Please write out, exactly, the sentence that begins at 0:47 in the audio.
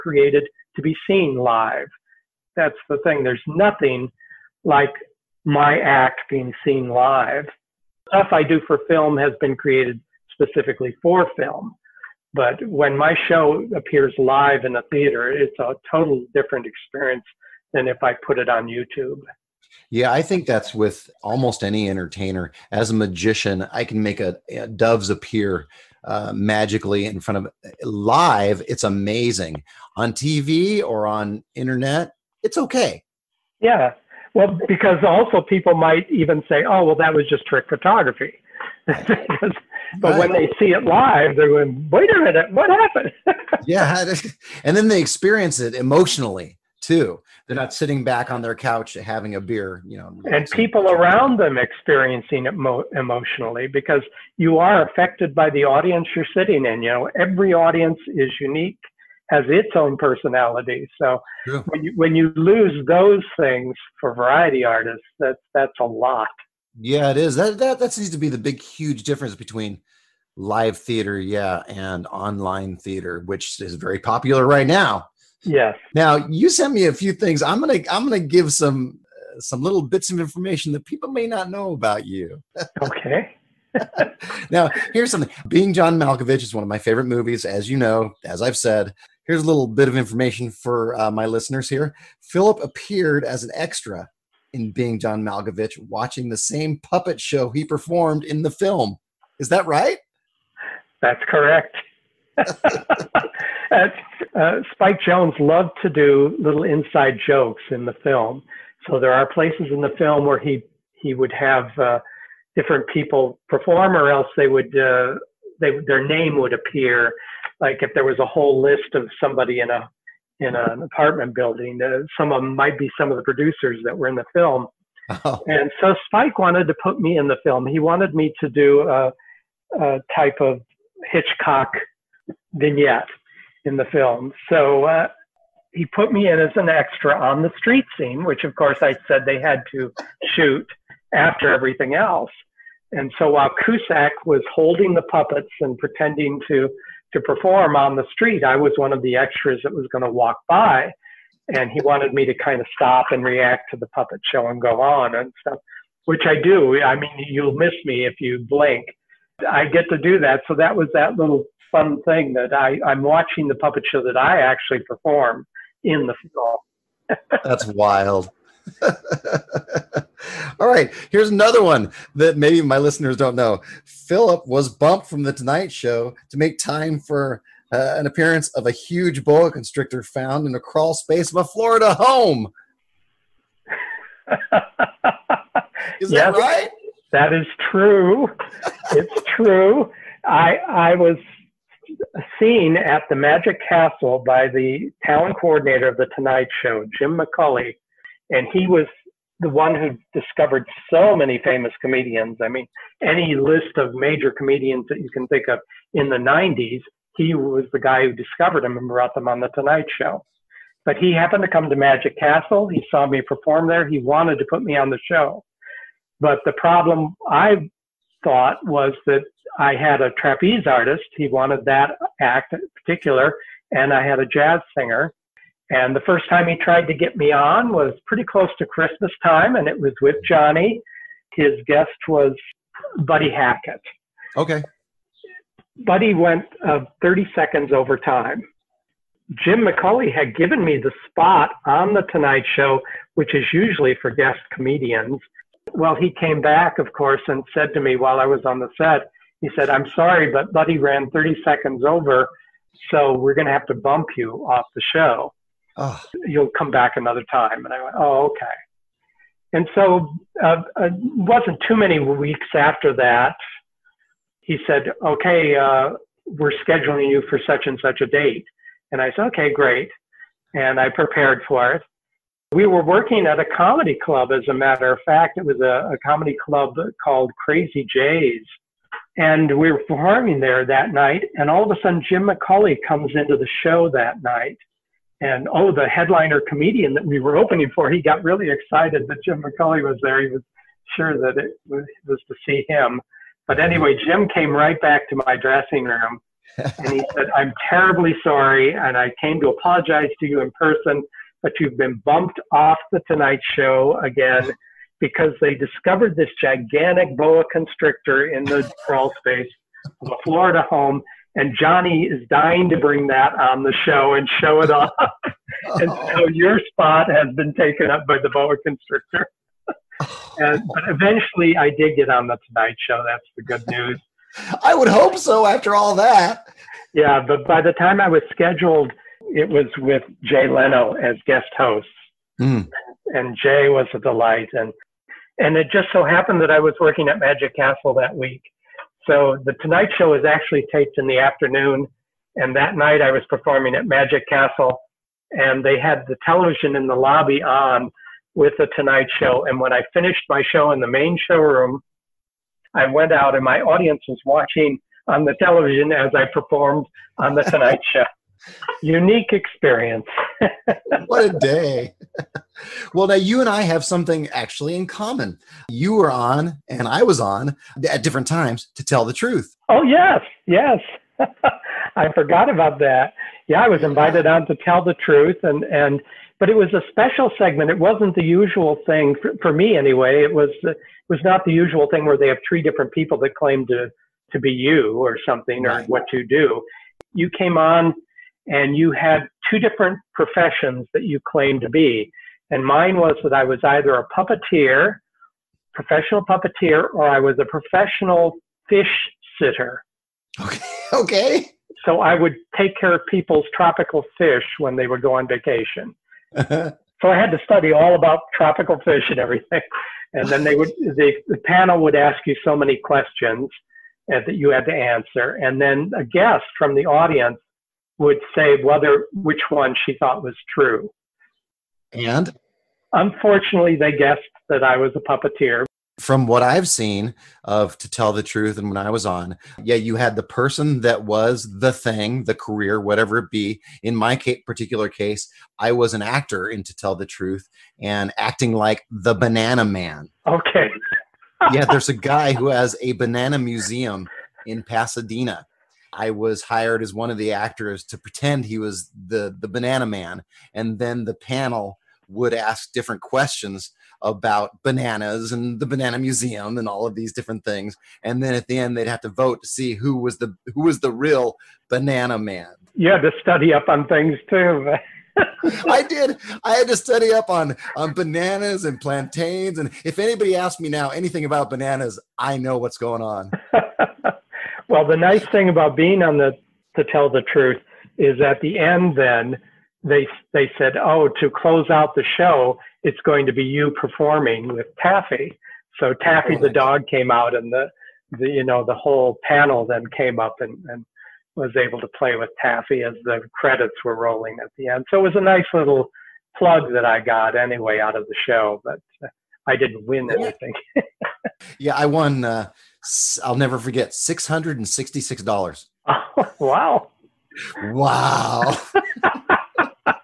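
They're not sitting back on their couch having a beer, you know.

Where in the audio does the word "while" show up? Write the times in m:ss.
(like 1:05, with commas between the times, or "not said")
2:23, 4:07.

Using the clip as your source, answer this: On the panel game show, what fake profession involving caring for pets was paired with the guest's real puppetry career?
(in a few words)
Professional fish sitter.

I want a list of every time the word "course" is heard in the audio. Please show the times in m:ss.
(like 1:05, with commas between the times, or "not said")
2:18, 4:06.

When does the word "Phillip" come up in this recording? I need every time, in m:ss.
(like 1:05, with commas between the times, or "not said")
1:32, 2:53.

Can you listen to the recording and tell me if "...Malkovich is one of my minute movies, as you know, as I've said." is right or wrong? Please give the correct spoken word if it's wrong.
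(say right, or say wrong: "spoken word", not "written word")
wrong: "favorite", not "minute".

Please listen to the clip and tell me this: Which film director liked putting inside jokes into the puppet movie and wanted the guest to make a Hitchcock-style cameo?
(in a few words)
Spike Jonze.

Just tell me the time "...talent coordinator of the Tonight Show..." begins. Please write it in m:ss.
3:15.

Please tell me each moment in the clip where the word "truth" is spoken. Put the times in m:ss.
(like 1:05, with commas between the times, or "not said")
6:09, 6:15, 7:08, 7:17, 7:57.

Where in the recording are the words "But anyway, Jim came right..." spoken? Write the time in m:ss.
4:53.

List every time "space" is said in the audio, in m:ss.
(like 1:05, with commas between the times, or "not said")
3:00, 5:09.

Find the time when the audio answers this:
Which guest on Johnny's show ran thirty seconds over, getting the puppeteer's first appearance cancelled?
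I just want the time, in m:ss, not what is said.
3:53.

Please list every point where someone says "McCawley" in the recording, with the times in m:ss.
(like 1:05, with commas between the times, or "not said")
3:17, 3:59, 4:42, 4:49.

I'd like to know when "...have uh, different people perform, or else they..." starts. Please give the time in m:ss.
1:51.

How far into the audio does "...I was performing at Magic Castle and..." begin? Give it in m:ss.
5:43.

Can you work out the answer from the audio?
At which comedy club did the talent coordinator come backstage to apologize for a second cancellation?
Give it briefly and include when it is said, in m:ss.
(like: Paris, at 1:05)
Crazy Jays, at 4:37.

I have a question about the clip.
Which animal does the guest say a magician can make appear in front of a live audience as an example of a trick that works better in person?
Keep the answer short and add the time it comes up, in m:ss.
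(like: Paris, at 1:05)
Doves, at 0:24.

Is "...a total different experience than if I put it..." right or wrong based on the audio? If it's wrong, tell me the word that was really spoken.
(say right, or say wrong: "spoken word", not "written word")
right.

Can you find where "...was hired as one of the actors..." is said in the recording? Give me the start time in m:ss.
7:26.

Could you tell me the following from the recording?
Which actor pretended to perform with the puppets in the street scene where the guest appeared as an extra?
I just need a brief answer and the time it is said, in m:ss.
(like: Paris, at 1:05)
Cusack, at 2:23.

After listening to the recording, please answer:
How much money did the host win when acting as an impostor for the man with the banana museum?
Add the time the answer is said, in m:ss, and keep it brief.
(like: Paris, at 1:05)
$666, at 8:23.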